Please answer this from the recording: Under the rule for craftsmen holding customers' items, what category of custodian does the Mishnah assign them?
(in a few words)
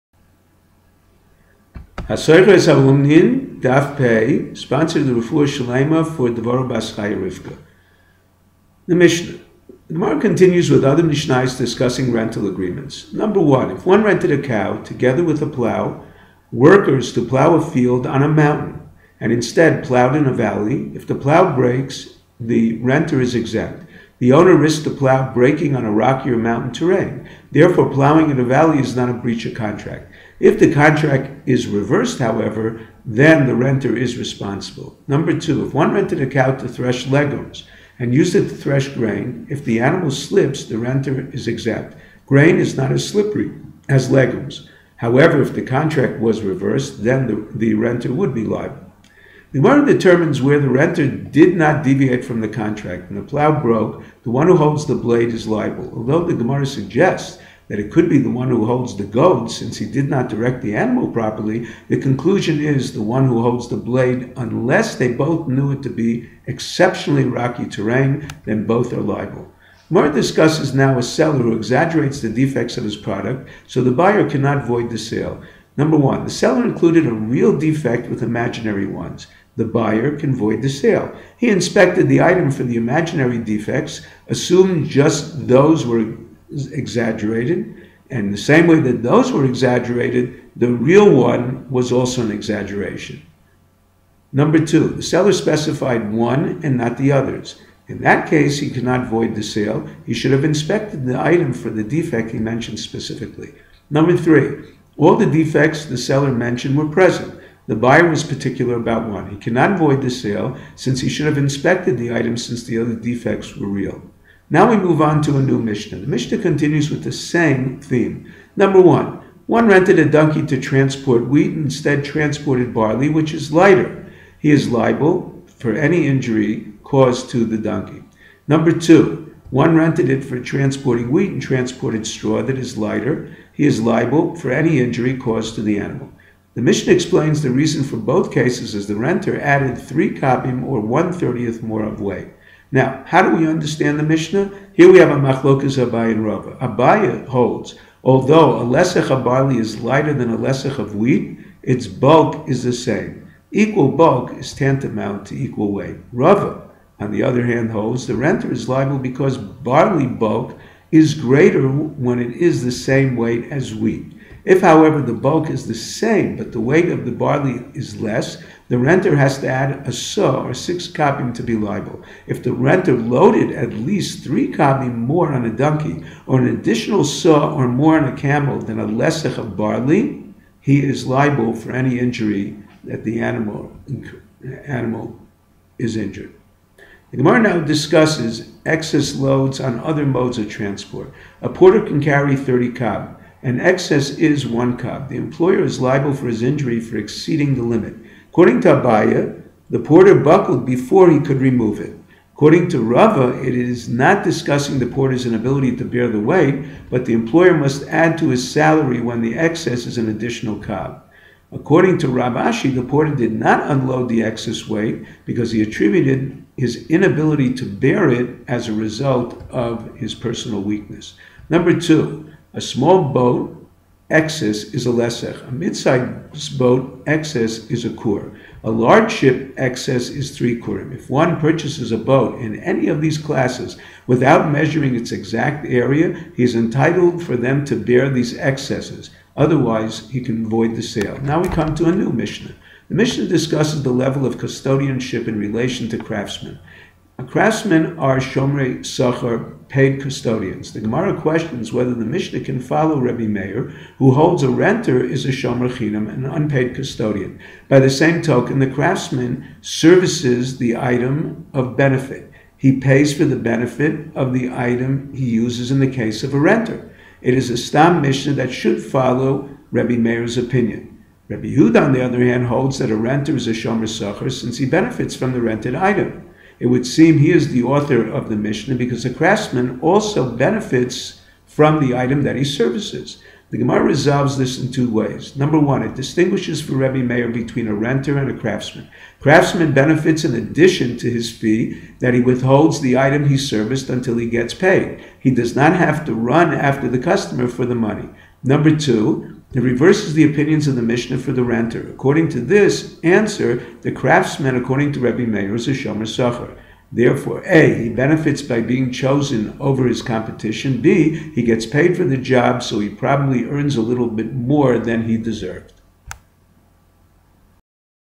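Shomrei sachar.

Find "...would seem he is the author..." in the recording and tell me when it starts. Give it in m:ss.
4:36.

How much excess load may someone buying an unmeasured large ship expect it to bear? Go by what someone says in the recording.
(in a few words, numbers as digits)
3 kurim.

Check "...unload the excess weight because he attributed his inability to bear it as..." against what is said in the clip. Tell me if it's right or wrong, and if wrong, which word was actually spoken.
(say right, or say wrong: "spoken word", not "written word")
right.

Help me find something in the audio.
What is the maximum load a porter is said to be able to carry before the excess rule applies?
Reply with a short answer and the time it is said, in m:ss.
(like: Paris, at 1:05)
30 cob, at 3:12.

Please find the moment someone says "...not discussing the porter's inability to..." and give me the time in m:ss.
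3:23.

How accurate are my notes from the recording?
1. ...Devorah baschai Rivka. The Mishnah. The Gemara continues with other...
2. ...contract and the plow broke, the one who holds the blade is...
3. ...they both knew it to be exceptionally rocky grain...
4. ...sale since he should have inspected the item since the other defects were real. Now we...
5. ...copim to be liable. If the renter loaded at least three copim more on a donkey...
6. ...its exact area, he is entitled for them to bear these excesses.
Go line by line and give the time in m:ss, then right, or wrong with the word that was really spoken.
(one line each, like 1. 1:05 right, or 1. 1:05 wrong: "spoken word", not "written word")
1. 0:06 right
2. 0:52 right
3. 1:04 wrong: "terrain", not "grain"
4. 1:50 right
5. 2:50 right
6. 3:54 right.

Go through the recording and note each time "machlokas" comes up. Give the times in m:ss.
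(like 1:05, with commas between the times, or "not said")
2:25.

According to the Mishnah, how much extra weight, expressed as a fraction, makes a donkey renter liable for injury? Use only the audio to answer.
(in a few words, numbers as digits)
1/30.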